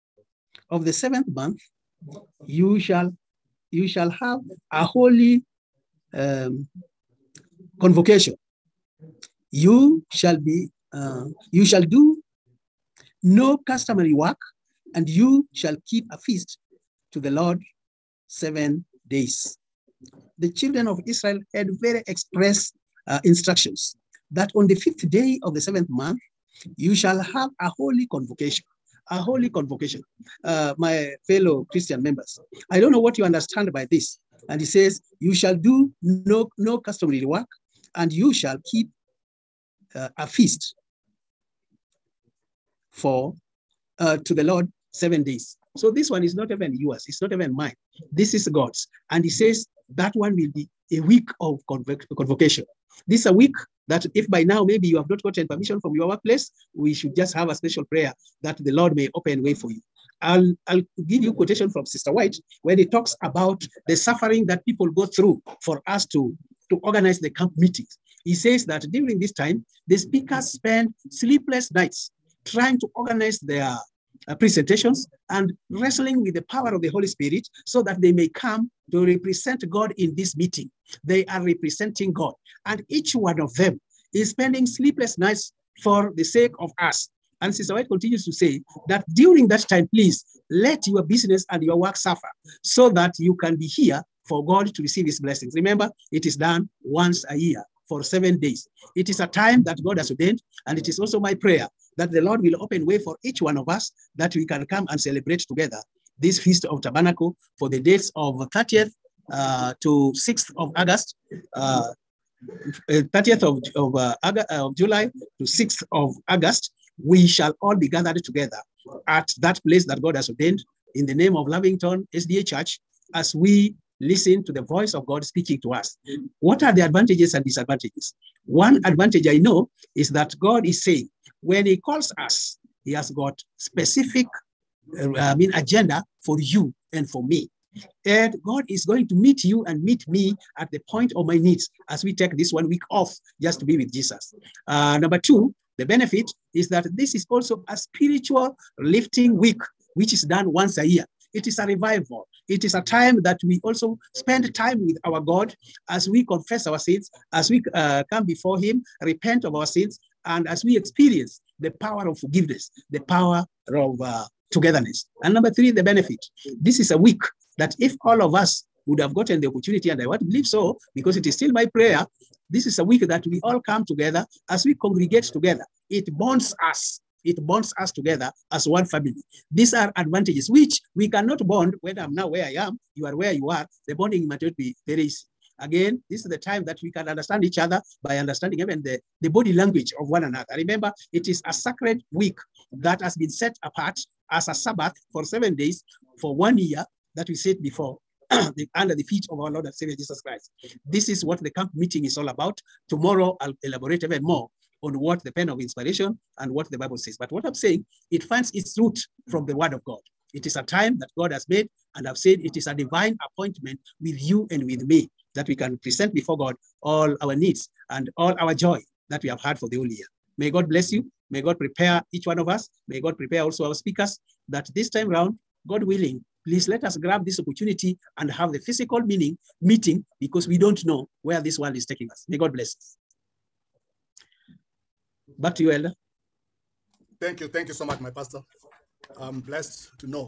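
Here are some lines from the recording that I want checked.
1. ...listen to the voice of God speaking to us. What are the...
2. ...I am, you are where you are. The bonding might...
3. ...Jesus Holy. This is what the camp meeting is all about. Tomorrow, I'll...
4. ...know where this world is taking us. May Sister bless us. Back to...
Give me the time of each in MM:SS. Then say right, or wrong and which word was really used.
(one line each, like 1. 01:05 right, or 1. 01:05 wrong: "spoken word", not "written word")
1. 02:04 right
2. 03:02 right
3. 03:19 wrong: "Christ", not "Holy"
4. 03:50 wrong: "God", not "Sister".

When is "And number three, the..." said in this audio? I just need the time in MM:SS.
02:45.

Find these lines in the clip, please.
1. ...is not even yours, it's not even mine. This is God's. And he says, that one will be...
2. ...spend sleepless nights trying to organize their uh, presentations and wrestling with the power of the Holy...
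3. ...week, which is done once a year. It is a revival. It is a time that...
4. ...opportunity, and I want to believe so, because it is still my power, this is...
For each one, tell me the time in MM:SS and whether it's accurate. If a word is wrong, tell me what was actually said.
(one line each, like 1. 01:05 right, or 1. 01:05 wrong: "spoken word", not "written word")
1. 00:46 right
2. 01:10 right
3. 02:29 right
4. 02:49 wrong: "prayer", not "power".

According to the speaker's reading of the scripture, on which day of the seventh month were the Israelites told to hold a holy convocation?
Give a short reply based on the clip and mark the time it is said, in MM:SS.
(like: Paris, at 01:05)
fifth day, at 00:24.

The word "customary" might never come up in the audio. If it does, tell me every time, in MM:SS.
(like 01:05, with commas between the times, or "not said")
00:13, 00:36.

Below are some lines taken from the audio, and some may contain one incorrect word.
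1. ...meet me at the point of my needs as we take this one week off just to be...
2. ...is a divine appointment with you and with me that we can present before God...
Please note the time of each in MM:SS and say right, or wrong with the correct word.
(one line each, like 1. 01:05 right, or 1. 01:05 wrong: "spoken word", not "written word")
1. 02:19 right
2. 03:32 right.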